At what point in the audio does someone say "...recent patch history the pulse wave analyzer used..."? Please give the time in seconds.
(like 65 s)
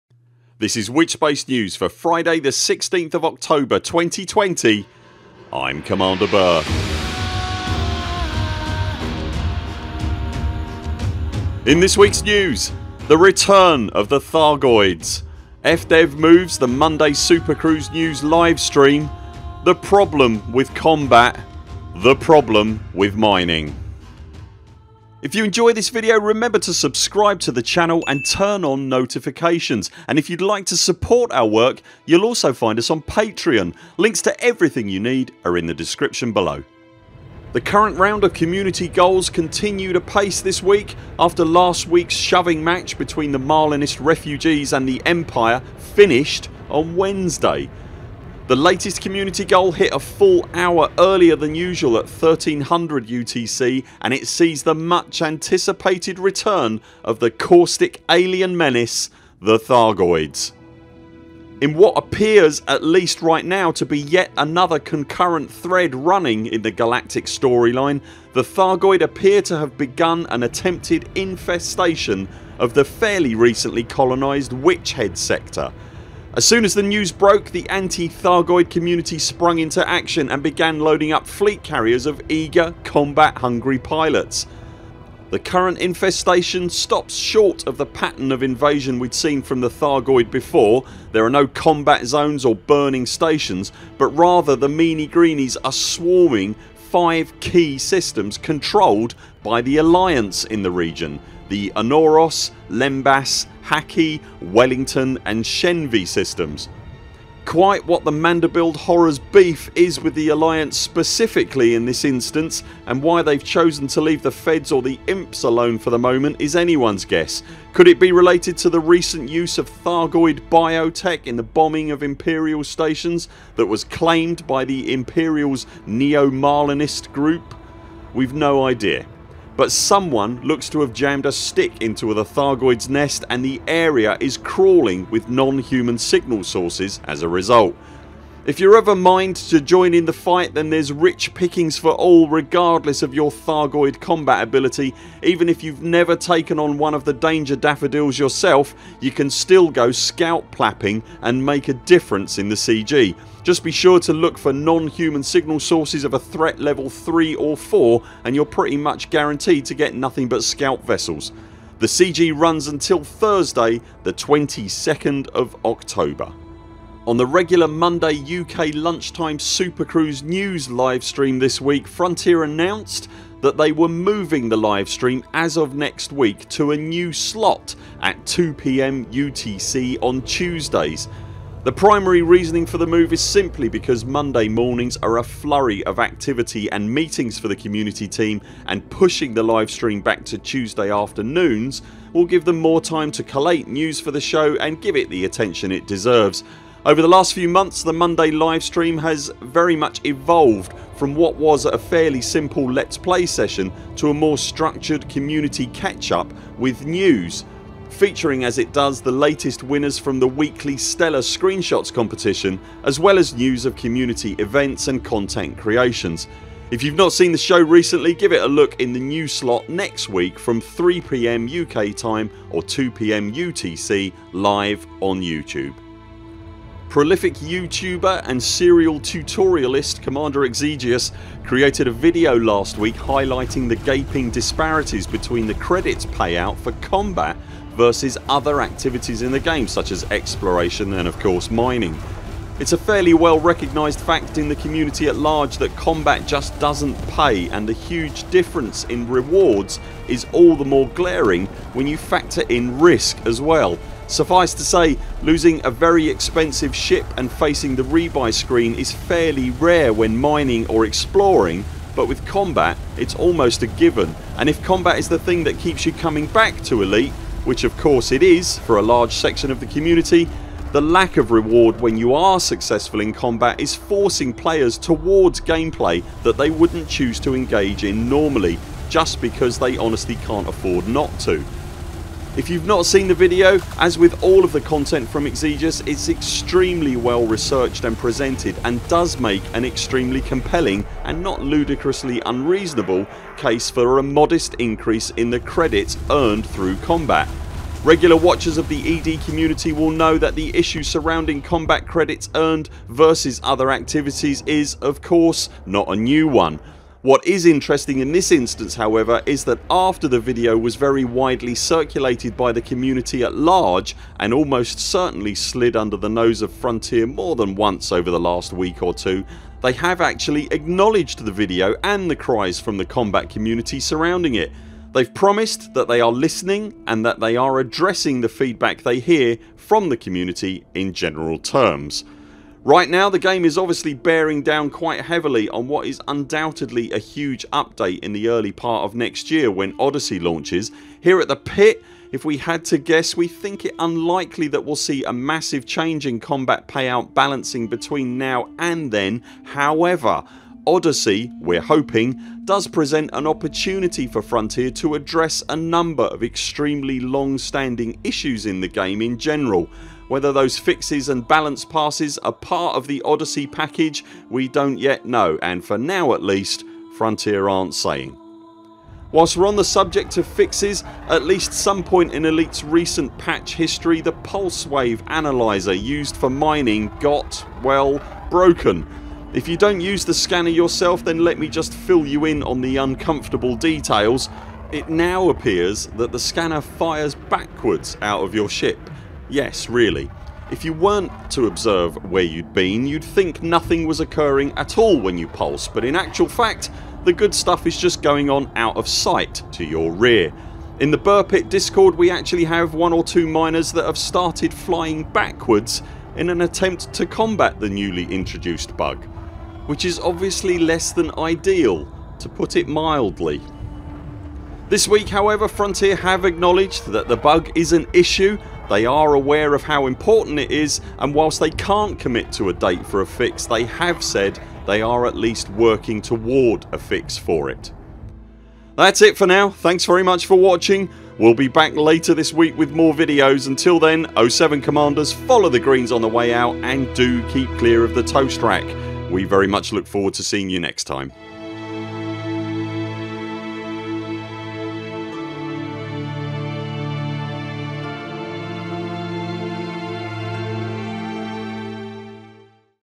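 372 s.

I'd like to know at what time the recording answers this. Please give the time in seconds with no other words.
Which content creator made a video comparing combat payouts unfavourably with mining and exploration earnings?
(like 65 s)
230 s.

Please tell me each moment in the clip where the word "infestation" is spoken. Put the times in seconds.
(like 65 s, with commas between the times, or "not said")
71 s, 85 s.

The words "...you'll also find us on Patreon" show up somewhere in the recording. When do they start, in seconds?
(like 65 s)
32 s.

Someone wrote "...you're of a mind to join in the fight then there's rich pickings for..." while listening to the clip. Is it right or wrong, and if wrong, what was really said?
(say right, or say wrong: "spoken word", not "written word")
right.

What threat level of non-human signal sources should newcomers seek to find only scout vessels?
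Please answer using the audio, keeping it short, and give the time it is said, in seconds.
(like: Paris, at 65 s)
3 or 4, at 156 s.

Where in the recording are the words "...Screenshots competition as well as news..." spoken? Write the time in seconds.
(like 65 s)
211 s.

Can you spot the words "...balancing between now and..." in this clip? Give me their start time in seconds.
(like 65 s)
347 s.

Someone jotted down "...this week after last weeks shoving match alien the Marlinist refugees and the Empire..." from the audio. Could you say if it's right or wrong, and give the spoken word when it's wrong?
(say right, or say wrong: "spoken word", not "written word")
wrong: "between", not "alien".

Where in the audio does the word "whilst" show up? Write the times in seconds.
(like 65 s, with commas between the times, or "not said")
369 s, 421 s.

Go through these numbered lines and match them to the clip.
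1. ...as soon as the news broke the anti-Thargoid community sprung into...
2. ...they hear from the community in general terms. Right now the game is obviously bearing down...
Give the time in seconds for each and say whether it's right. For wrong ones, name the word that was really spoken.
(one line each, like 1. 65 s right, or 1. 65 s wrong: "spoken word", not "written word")
1. 76 s right
2. 328 s right.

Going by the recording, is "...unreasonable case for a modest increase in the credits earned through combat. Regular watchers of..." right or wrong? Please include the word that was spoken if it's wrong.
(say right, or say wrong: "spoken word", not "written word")
right.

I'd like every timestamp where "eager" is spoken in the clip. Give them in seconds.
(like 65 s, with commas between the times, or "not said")
82 s.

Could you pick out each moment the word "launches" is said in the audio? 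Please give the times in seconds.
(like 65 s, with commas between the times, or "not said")
340 s.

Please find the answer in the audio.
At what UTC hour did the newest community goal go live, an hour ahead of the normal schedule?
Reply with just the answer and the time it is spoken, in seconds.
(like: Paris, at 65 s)
1300 UTC, at 52 s.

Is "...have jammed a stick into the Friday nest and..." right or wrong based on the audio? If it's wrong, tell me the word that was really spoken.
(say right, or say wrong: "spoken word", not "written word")
wrong: "Thargoids", not "Friday".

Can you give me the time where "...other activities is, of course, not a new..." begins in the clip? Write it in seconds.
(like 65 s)
303 s.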